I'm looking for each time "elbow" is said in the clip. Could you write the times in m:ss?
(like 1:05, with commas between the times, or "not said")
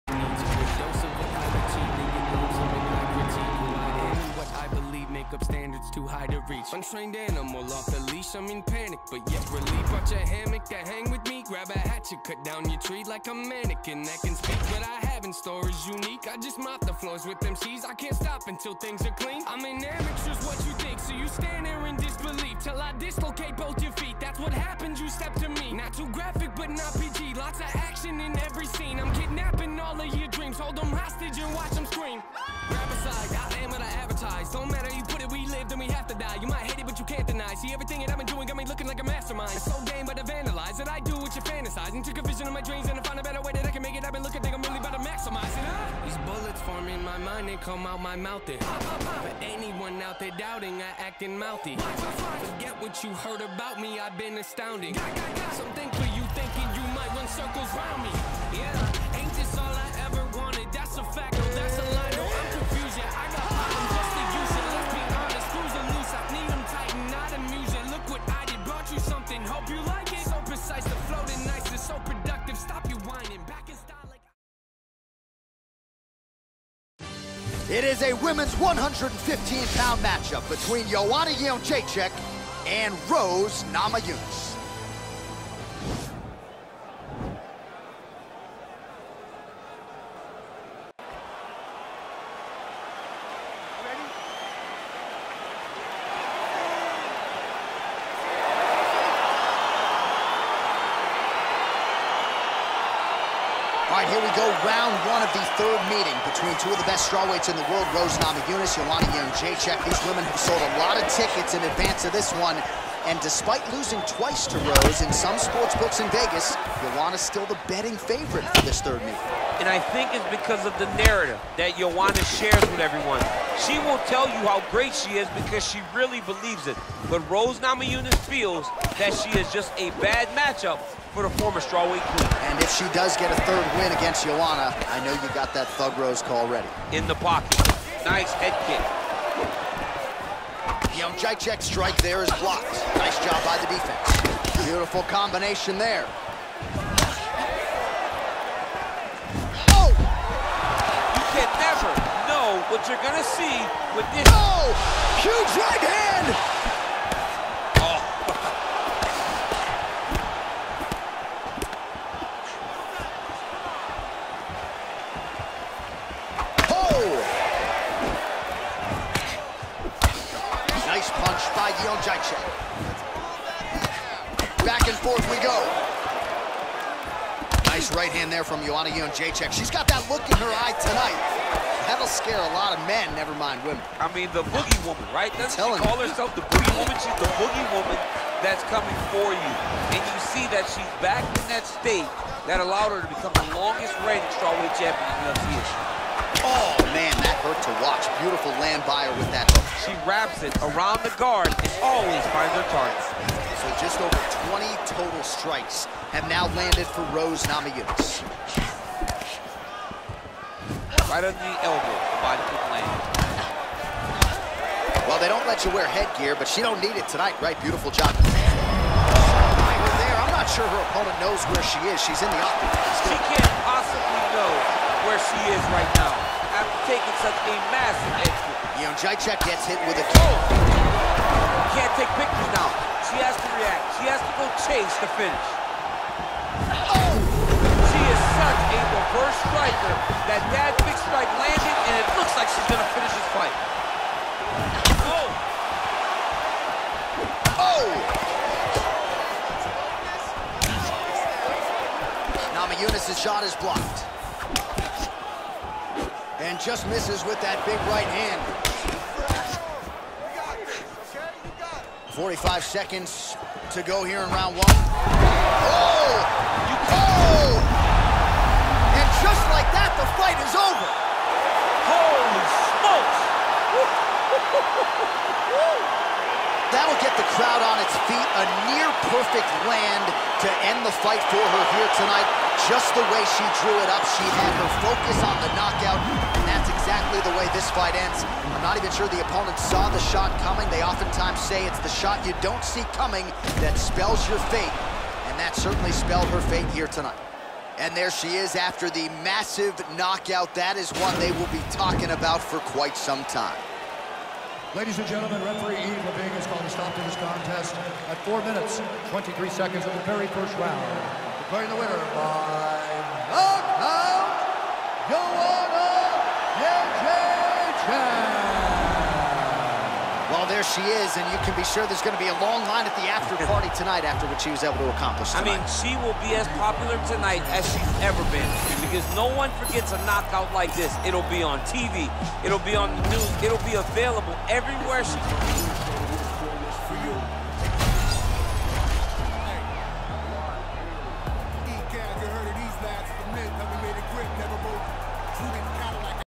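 3:31.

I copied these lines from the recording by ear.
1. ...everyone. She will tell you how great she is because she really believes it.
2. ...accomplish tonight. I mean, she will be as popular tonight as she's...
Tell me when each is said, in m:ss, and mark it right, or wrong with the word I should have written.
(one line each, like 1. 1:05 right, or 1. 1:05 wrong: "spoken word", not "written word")
1. 2:02 right
2. 5:24 right.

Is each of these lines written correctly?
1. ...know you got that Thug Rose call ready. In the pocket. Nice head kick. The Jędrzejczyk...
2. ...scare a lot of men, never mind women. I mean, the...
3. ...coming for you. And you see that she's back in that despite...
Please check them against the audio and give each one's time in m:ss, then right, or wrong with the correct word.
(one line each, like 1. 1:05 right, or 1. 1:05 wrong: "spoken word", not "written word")
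1. 2:15 right
2. 3:02 right
3. 3:08 wrong: "state", not "despite".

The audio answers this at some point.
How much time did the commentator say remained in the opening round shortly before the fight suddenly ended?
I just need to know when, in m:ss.
4:22.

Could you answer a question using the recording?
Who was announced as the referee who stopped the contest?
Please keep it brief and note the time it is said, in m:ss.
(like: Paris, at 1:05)
Eve Leving, at 5:05.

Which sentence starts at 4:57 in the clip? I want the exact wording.
And there she is after the massive knockout.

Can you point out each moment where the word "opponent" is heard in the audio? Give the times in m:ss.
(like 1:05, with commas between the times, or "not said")
3:40, 4:49.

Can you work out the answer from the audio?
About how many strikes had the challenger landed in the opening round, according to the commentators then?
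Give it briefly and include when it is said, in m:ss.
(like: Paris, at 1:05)
20, at 3:24.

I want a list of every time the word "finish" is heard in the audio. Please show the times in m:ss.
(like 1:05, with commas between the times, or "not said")
3:55, 4:02.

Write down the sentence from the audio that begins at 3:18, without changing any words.
Beautiful land buyer with that hook.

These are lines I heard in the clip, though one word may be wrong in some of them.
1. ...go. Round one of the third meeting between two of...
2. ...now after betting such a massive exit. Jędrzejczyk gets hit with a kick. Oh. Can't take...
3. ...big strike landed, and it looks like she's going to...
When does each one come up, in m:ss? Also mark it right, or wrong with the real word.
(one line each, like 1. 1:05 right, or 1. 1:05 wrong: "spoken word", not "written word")
1. 1:44 right
2. 3:45 wrong: "taking", not "betting"
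3. 4:00 right.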